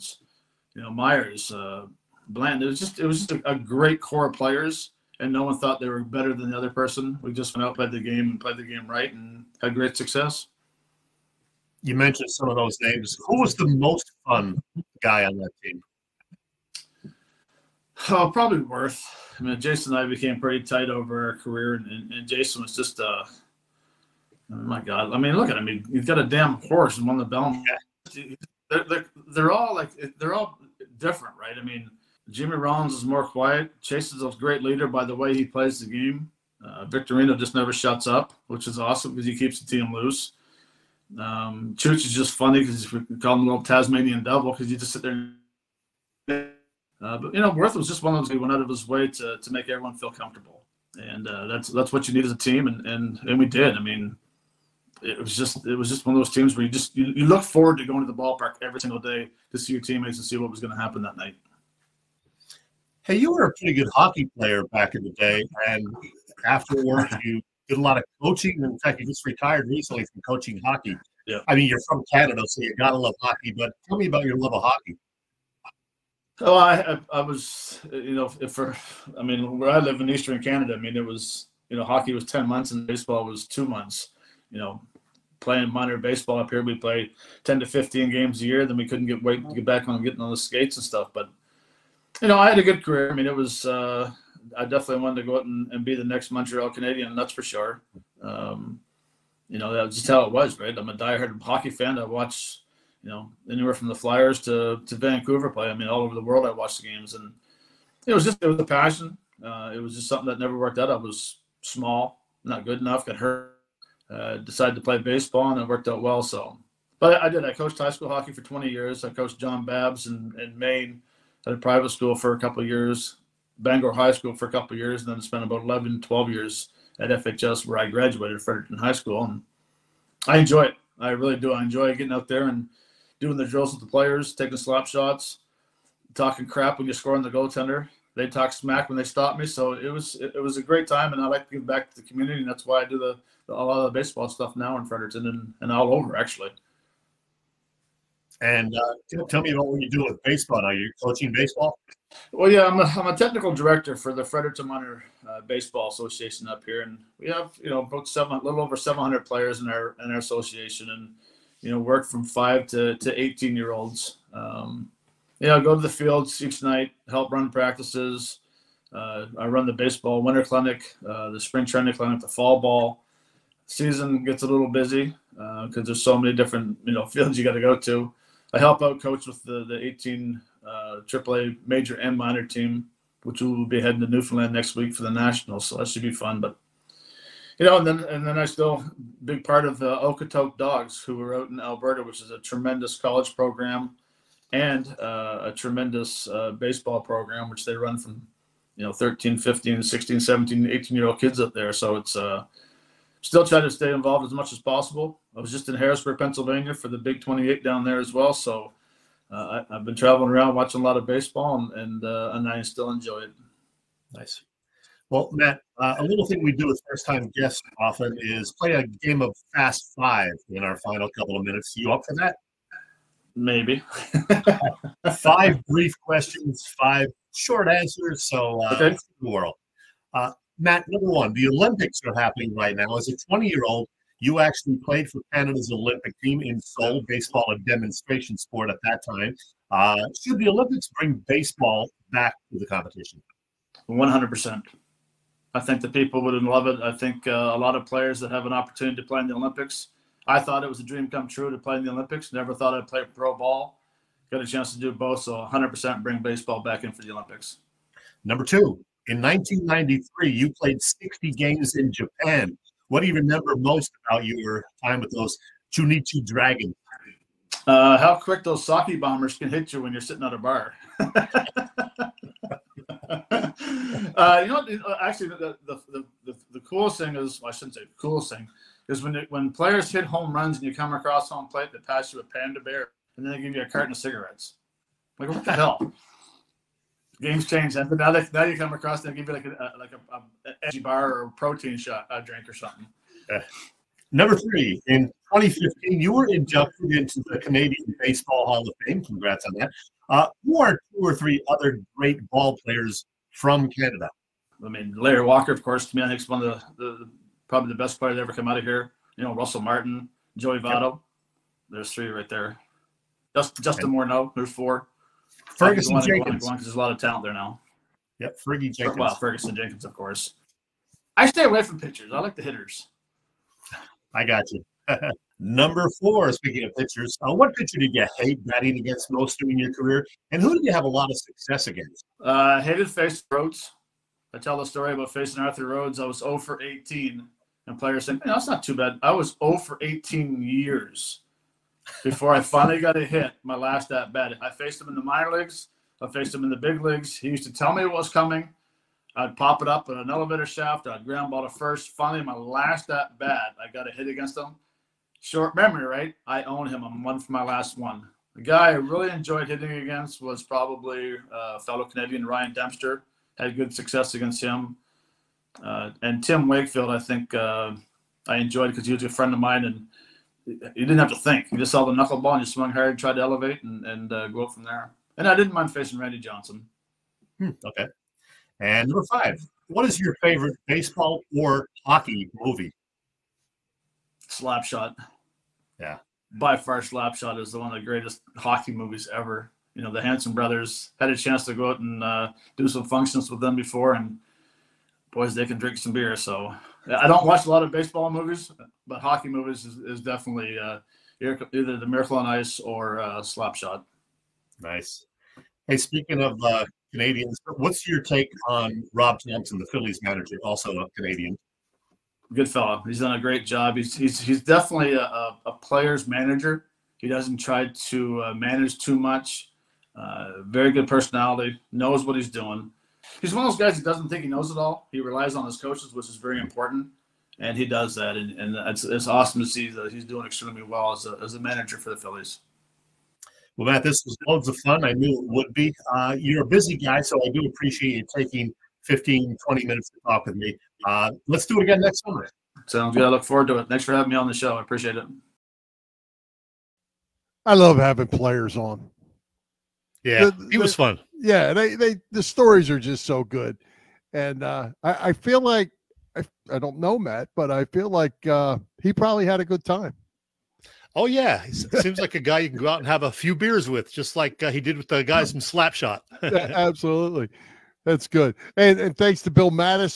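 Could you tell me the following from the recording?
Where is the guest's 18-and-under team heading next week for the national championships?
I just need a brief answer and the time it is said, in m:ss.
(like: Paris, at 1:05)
Newfoundland, at 3:04.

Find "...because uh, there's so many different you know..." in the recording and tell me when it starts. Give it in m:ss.
2:55.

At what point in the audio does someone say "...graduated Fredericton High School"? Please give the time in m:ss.
2:07.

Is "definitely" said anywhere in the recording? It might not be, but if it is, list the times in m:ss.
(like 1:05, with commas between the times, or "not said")
1:34, 6:40, 6:54.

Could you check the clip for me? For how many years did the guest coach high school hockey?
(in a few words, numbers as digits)
20.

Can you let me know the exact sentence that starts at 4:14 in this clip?
Got a chance to do both, so 100% bring baseball back in for the Olympics.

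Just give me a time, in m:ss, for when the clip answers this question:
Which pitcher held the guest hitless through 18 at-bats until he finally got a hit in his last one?
5:35.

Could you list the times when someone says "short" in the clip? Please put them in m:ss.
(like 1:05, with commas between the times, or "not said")
3:47, 5:55.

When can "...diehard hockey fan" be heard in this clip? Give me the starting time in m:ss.
1:40.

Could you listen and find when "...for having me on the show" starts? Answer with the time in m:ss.
7:23.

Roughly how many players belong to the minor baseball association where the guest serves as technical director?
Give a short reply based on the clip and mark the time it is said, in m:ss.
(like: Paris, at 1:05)
700, at 2:38.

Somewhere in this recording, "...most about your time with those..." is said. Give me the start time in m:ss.
4:23.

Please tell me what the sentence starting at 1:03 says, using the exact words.
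Hey, you were a pretty good hockey player back in the day, and afterwards you did a lot of coaching.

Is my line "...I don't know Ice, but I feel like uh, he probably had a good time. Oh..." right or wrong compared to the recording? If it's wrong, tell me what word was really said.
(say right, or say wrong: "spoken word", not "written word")
wrong: "Matt", not "Ice".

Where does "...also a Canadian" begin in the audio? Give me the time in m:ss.
6:50.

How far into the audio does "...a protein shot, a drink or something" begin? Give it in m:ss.
4:51.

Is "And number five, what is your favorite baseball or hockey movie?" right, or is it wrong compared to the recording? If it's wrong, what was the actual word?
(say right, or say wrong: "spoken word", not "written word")
right.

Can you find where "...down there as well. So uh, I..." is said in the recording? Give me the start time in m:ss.
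3:27.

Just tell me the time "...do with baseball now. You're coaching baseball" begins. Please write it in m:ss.
2:29.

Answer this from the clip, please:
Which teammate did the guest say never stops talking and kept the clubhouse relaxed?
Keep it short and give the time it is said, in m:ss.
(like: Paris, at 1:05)
Victorino, at 0:36.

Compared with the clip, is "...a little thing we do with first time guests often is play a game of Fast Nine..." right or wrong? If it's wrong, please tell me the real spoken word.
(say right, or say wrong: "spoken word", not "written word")
wrong: "Five", not "Nine".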